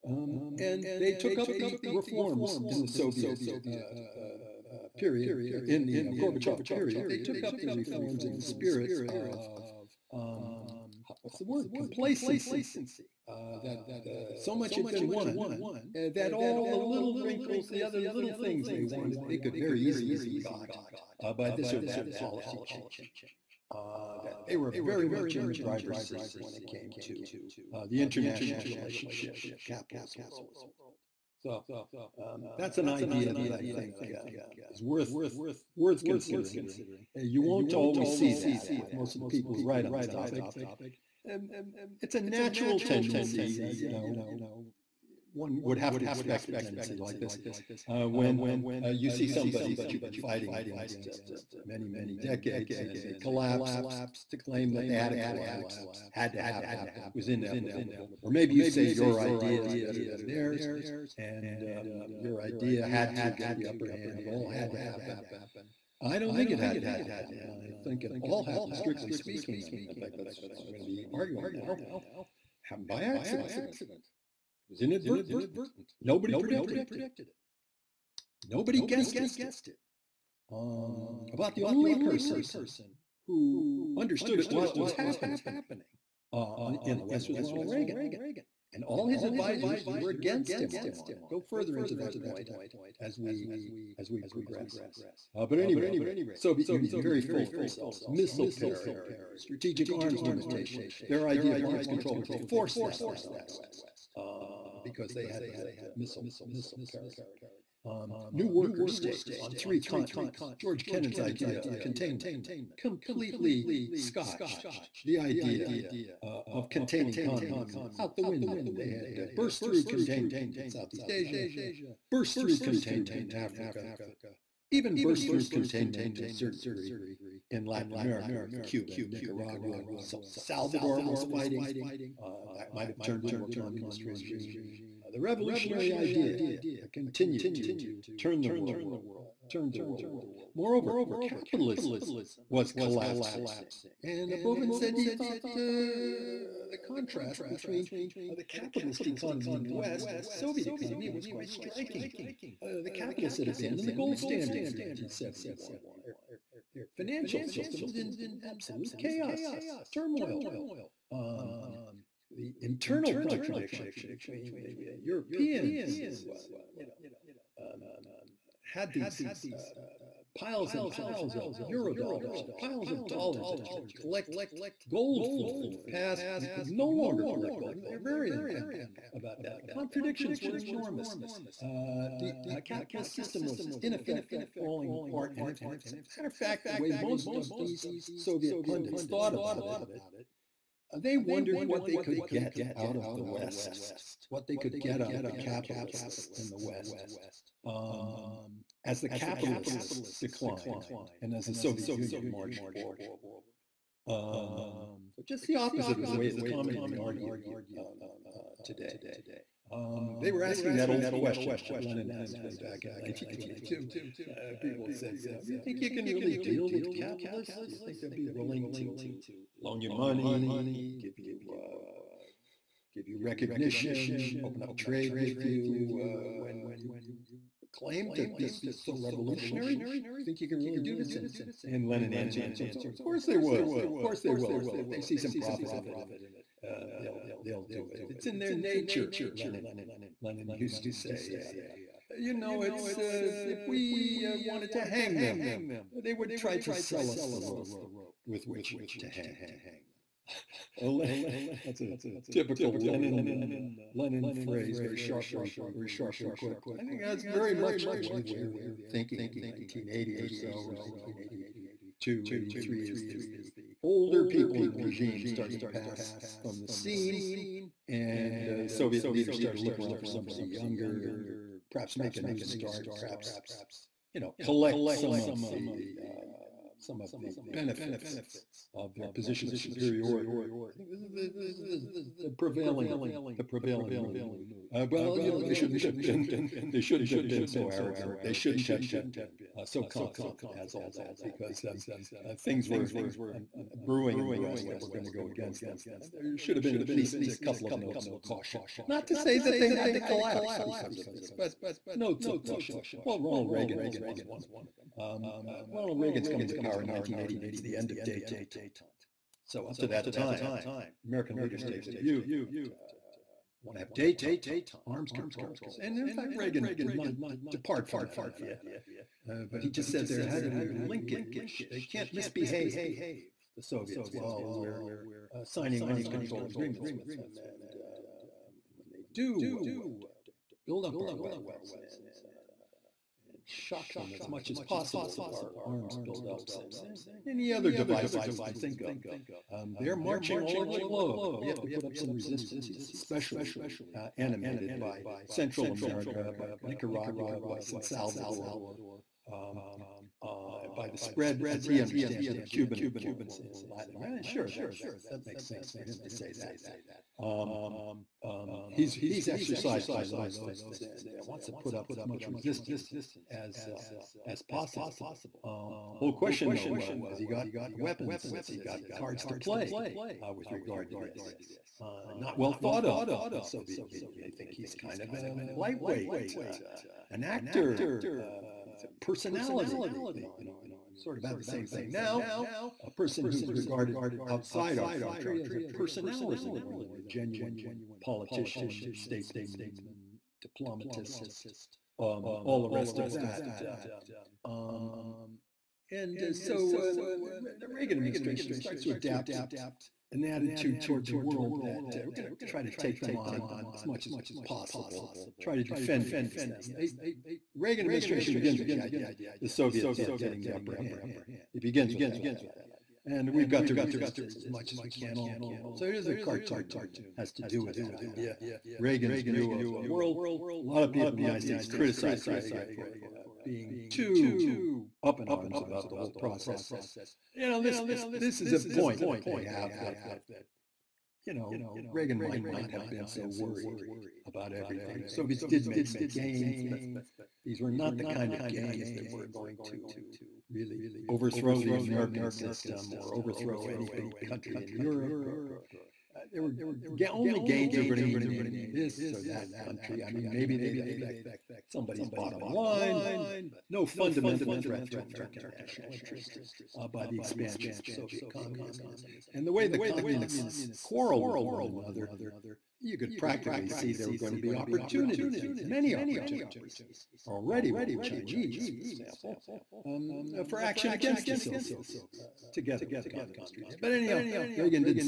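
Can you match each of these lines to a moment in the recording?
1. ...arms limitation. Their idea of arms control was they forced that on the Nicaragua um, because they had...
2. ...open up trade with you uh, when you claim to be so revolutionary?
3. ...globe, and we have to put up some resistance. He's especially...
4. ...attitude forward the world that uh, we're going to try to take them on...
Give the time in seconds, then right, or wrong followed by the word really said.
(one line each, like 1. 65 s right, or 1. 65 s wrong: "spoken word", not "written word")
1. 99 s wrong: "West", not "Nicaragua"
2. 224 s right
3. 340 s right
4. 400 s wrong: "toward", not "forward".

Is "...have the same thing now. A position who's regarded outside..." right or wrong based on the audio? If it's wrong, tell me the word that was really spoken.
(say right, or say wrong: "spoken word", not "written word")
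wrong: "person", not "position".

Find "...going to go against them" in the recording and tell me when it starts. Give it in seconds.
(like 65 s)
294 s.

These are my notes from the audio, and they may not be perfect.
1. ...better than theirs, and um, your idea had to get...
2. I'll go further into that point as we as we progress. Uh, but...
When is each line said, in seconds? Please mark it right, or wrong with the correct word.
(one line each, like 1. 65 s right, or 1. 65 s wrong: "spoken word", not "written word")
1. 59 s right
2. 91 s right.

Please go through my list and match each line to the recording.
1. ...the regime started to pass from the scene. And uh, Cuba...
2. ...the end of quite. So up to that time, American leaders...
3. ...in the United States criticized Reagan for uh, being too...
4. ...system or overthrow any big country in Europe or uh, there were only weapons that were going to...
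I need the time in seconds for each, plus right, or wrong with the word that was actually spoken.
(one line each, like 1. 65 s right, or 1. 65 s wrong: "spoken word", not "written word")
1. 264 s wrong: "Soviet", not "Cuba"
2. 307 s wrong: "detente", not "quite"
3. 421 s right
4. 442 s wrong: "gains", not "weapons".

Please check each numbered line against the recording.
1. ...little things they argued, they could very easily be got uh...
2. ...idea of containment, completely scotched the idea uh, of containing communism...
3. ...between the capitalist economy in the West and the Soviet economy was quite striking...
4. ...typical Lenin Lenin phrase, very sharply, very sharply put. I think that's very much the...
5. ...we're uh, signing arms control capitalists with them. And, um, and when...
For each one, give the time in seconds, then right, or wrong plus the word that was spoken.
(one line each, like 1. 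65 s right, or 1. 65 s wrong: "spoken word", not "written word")
1. 18 s wrong: "wanted", not "argued"
2. 111 s right
3. 147 s right
4. 252 s right
5. 324 s wrong: "agreements", not "capitalists".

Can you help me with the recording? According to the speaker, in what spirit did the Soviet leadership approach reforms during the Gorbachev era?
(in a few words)
complacency.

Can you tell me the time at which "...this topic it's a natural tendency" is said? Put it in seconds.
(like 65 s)
39 s.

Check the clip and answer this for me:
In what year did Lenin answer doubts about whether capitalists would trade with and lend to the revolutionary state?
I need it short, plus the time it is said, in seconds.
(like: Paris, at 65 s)
1922, at 212 s.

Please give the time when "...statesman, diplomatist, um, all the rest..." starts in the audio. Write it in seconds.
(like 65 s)
388 s.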